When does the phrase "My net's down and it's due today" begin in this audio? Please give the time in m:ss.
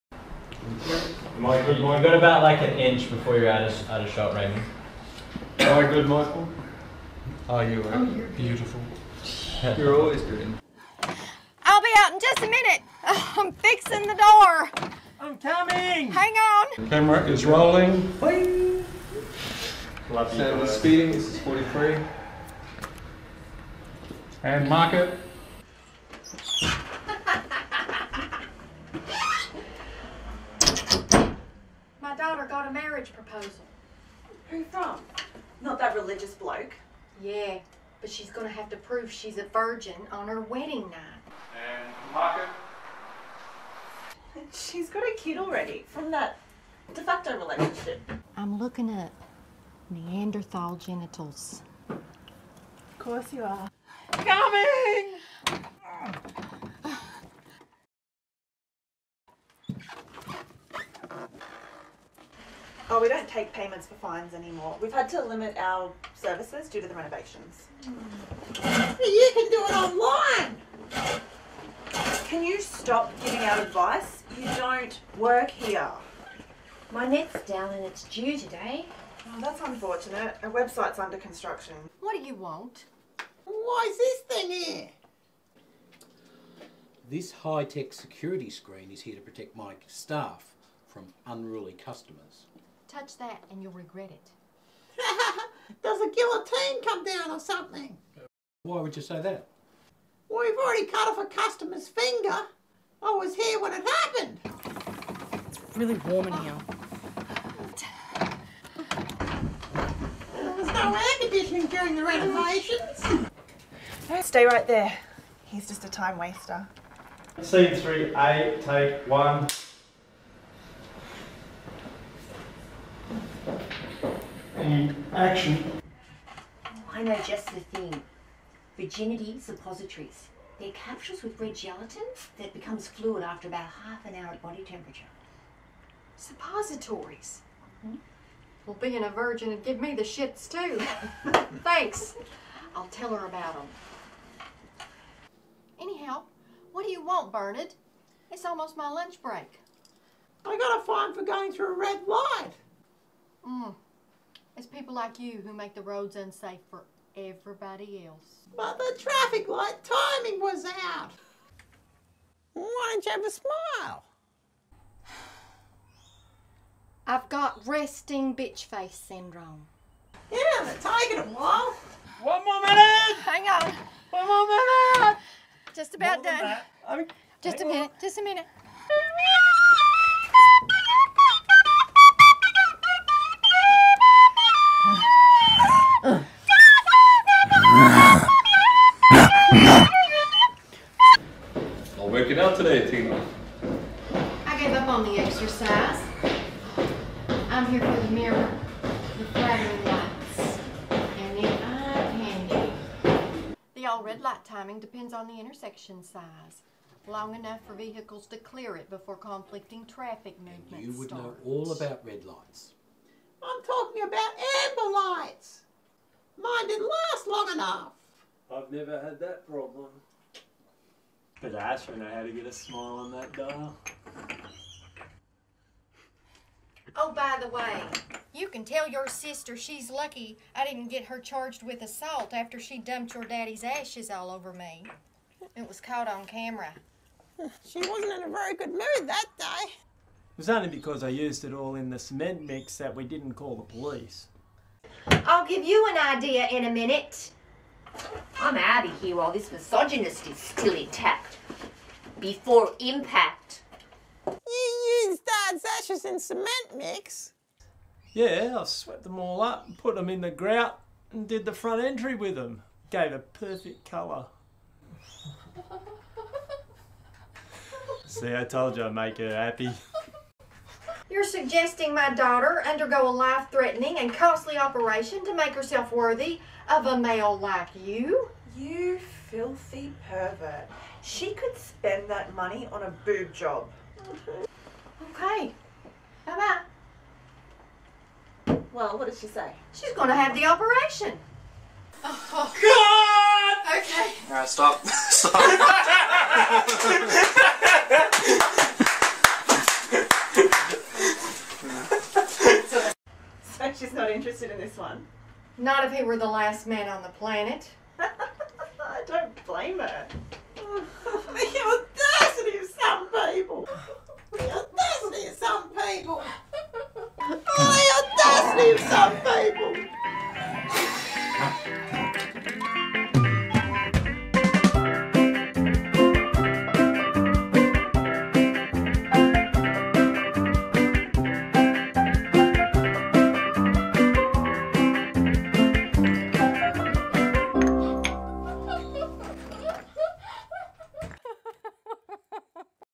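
1:16.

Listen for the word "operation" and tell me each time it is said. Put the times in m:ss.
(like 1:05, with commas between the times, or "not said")
4:34, 4:50.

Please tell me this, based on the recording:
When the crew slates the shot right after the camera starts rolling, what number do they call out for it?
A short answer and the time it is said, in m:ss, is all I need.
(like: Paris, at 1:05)
43, at 0:21.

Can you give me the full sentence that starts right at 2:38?
But the traffic light timing was out.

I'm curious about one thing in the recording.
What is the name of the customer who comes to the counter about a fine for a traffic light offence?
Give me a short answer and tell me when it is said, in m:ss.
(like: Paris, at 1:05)
Bernard, at 2:27.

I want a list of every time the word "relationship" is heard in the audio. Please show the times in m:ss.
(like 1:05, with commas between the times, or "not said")
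0:47.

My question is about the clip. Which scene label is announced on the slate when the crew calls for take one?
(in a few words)
Scene 3A.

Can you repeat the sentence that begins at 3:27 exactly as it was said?
Long enough for vehicles to clear it before conflicting traffic movements and You would start.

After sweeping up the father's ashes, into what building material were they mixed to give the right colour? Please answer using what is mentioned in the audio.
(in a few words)
Grout.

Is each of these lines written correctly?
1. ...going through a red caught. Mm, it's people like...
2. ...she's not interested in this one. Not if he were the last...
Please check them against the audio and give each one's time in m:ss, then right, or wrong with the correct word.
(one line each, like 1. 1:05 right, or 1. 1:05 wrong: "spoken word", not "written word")
1. 2:31 wrong: "light", not "caught"
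2. 5:03 right.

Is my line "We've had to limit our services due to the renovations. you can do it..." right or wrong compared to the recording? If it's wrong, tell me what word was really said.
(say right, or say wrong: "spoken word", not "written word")
right.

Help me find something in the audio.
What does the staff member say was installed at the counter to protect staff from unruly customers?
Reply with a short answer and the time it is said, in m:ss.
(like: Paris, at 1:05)
High-tech security screen, at 1:27.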